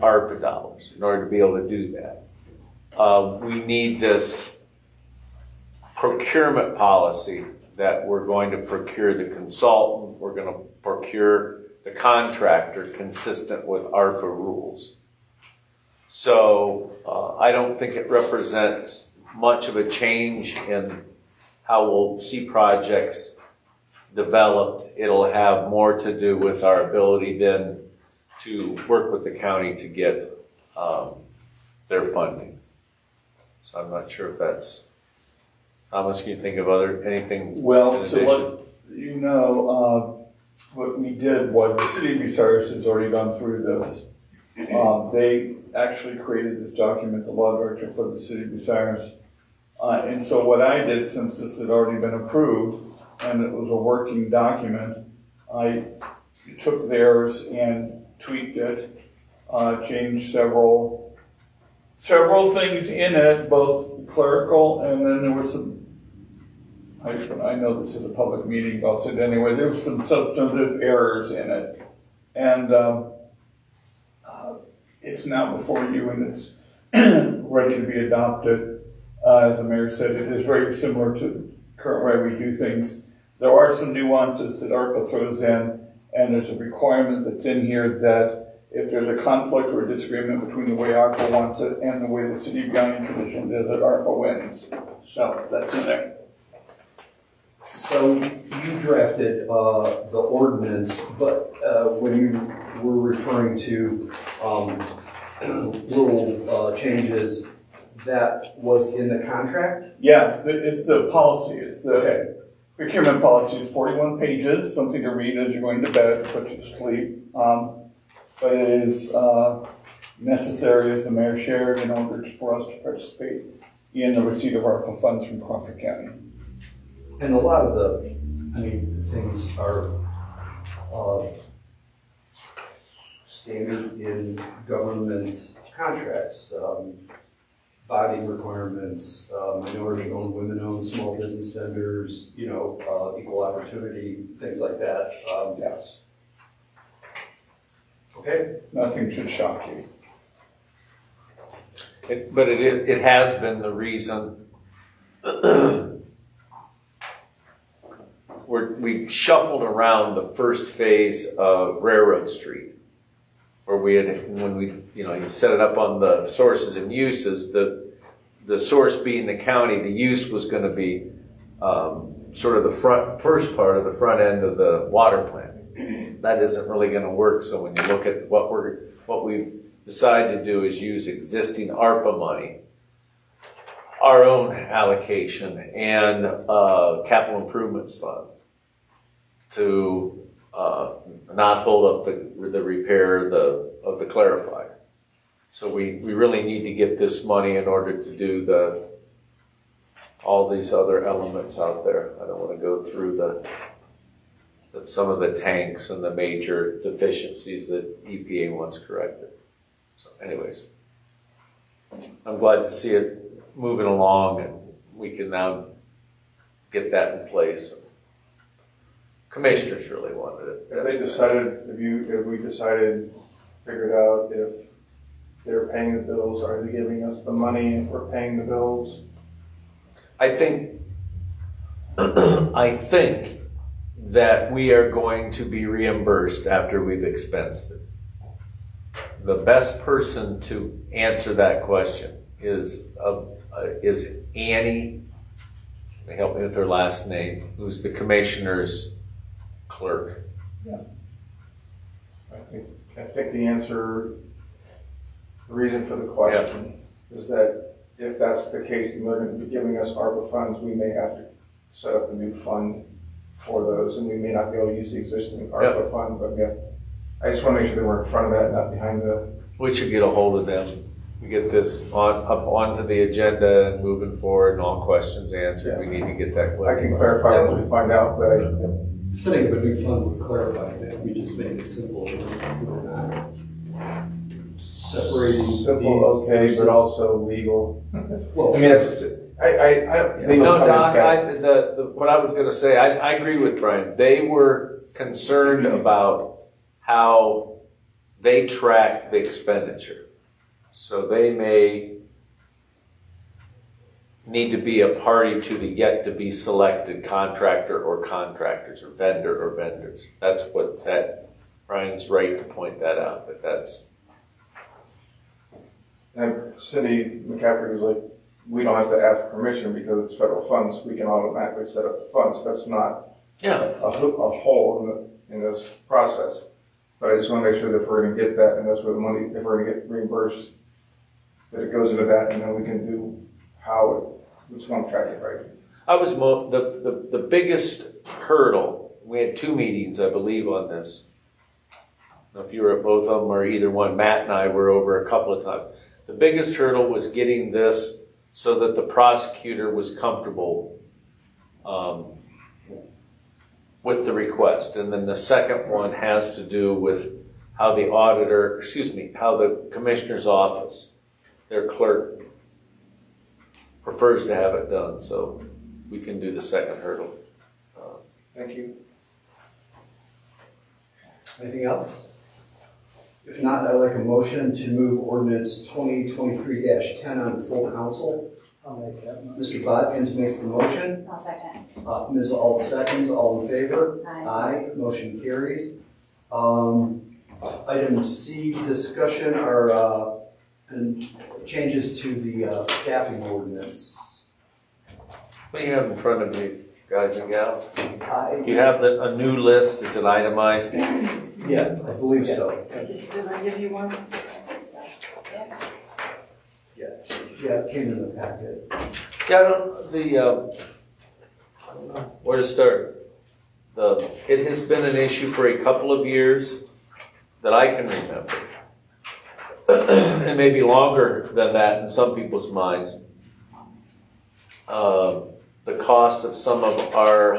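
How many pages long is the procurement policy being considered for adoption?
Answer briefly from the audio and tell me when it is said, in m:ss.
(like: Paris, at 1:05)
41, at 1:53.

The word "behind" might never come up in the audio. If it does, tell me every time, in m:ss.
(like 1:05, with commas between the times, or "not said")
4:28.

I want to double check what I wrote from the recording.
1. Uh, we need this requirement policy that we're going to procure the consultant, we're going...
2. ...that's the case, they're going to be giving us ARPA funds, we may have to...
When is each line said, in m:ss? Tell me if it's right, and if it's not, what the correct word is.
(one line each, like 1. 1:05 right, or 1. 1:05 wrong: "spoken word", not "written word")
1. 0:02 wrong: "procurement", not "requirement"
2. 4:18 right.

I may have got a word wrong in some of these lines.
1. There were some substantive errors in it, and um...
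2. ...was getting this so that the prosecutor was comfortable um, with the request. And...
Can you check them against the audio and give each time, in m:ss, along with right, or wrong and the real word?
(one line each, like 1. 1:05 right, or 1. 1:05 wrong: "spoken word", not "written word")
1. 1:09 right
2. 5:46 right.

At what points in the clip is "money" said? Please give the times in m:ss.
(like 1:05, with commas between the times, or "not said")
3:02, 3:17, 3:47, 5:28.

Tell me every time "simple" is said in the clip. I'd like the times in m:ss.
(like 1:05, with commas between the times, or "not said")
4:41, 4:45.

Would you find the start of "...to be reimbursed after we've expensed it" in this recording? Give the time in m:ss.
3:55.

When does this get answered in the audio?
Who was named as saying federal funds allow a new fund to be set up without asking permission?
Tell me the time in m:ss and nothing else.
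5:16.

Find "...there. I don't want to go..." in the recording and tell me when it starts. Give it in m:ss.
3:21.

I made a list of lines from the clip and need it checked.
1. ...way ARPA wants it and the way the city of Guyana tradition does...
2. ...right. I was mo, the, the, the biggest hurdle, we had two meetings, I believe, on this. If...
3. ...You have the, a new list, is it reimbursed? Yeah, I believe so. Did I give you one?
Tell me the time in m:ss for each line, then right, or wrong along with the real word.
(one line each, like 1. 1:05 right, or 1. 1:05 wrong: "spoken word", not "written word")
1. 1:30 right
2. 5:35 right
3. 6:38 wrong: "itemized", not "reimbursed".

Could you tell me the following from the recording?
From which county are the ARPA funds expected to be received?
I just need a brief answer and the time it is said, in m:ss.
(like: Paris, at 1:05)
Crawford County, at 2:05.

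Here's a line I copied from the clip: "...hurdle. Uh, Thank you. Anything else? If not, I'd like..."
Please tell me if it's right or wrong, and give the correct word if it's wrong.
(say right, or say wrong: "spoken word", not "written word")
right.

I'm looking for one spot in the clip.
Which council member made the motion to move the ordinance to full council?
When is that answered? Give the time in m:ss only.
6:19.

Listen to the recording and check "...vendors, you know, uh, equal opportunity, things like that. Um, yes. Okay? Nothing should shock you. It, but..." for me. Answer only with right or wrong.
right.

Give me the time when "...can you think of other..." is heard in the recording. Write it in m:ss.
0:36.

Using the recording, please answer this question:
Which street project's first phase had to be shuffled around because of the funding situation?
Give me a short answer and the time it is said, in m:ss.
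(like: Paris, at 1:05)
Railroad Street, at 2:41.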